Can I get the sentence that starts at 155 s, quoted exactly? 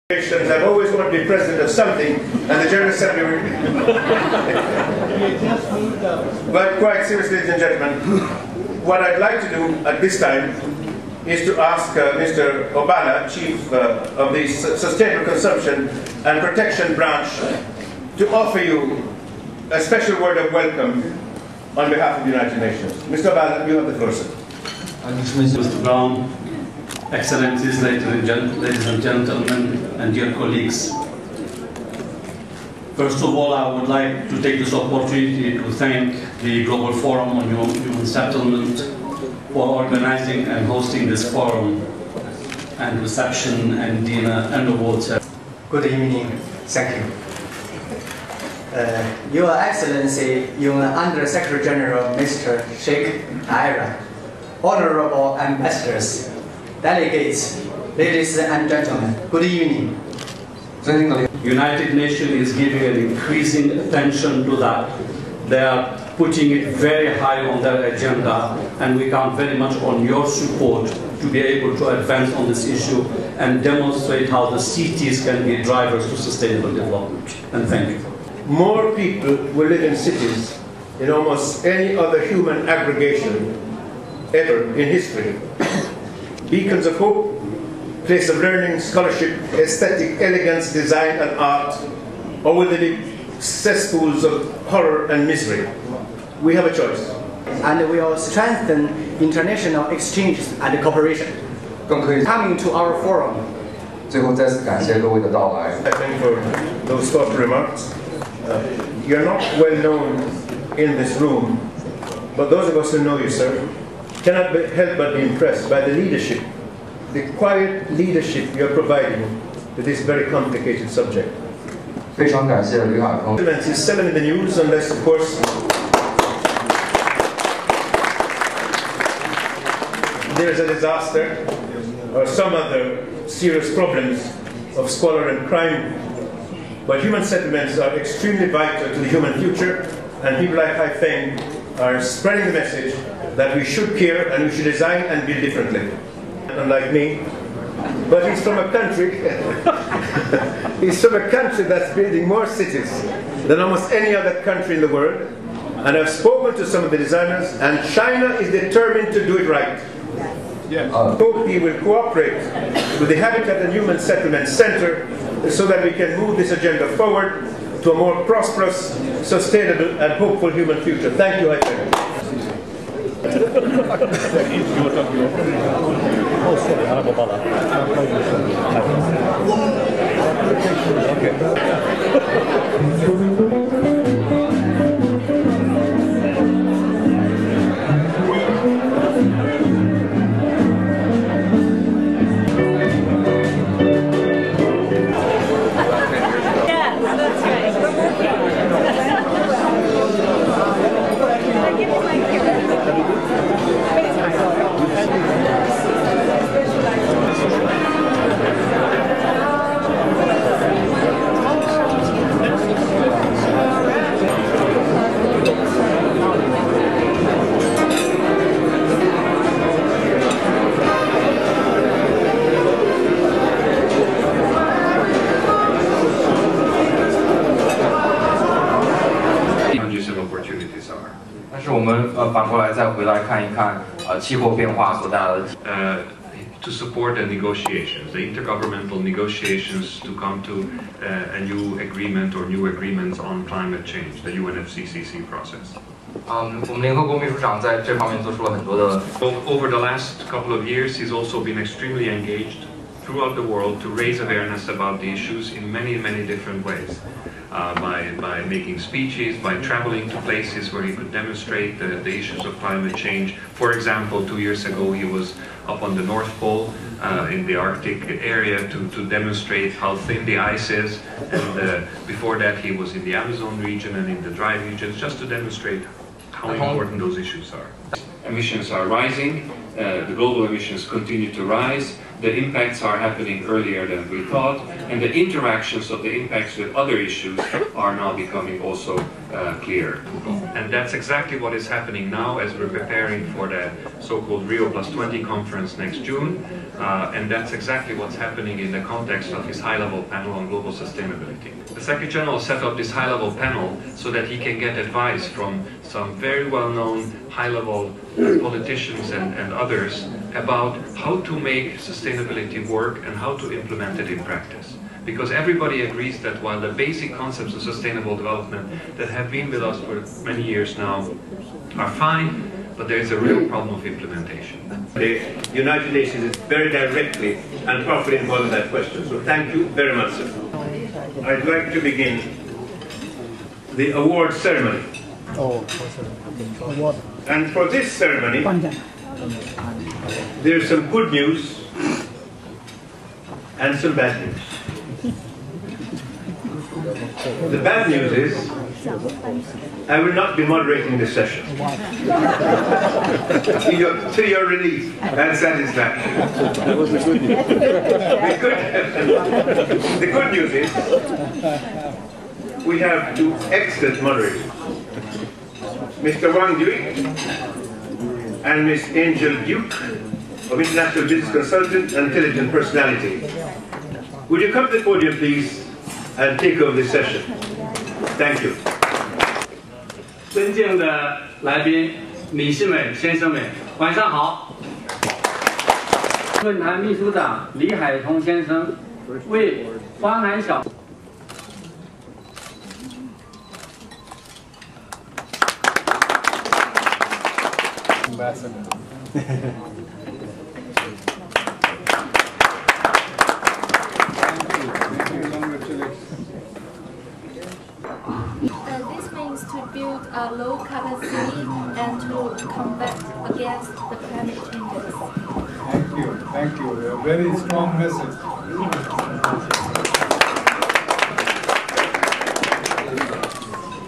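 And I've spoken to some of the designers, and China is determined to do it right.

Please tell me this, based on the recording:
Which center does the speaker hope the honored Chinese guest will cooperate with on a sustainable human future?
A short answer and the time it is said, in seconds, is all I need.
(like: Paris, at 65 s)
Habitat and Human Settlement Center, at 163 s.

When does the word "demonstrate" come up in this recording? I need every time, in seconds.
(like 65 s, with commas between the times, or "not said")
73 s, 261 s, 269 s, 275 s.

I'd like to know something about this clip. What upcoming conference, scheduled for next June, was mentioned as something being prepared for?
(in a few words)
Rio Plus 20.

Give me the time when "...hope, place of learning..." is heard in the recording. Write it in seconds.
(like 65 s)
86 s.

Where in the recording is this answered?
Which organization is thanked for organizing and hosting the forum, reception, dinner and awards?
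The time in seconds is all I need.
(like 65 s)
36 s.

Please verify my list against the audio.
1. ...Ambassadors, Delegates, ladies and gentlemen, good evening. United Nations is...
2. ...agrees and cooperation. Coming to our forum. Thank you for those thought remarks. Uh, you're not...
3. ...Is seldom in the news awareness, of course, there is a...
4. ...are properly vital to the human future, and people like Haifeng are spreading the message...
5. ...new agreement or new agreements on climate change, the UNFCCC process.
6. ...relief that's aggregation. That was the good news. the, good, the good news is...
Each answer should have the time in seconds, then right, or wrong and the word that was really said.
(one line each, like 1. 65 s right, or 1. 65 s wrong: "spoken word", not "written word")
1. 55 s right
2. 99 s wrong: "exchanges", not "agrees"
3. 123 s wrong: "unless", not "awareness"
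4. 137 s wrong: "extremely", not "properly"
5. 241 s right
6. 354 s wrong: "satisfaction", not "aggregation".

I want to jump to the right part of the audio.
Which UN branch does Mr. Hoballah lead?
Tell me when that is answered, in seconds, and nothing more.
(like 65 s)
14 s.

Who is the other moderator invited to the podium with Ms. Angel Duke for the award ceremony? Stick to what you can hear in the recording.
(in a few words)
Wang Dui.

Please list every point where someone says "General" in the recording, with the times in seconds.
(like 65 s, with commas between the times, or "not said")
2 s, 51 s, 302 s.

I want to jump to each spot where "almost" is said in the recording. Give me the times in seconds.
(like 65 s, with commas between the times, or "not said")
81 s, 153 s.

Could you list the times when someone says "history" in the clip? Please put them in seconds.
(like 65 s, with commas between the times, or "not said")
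84 s.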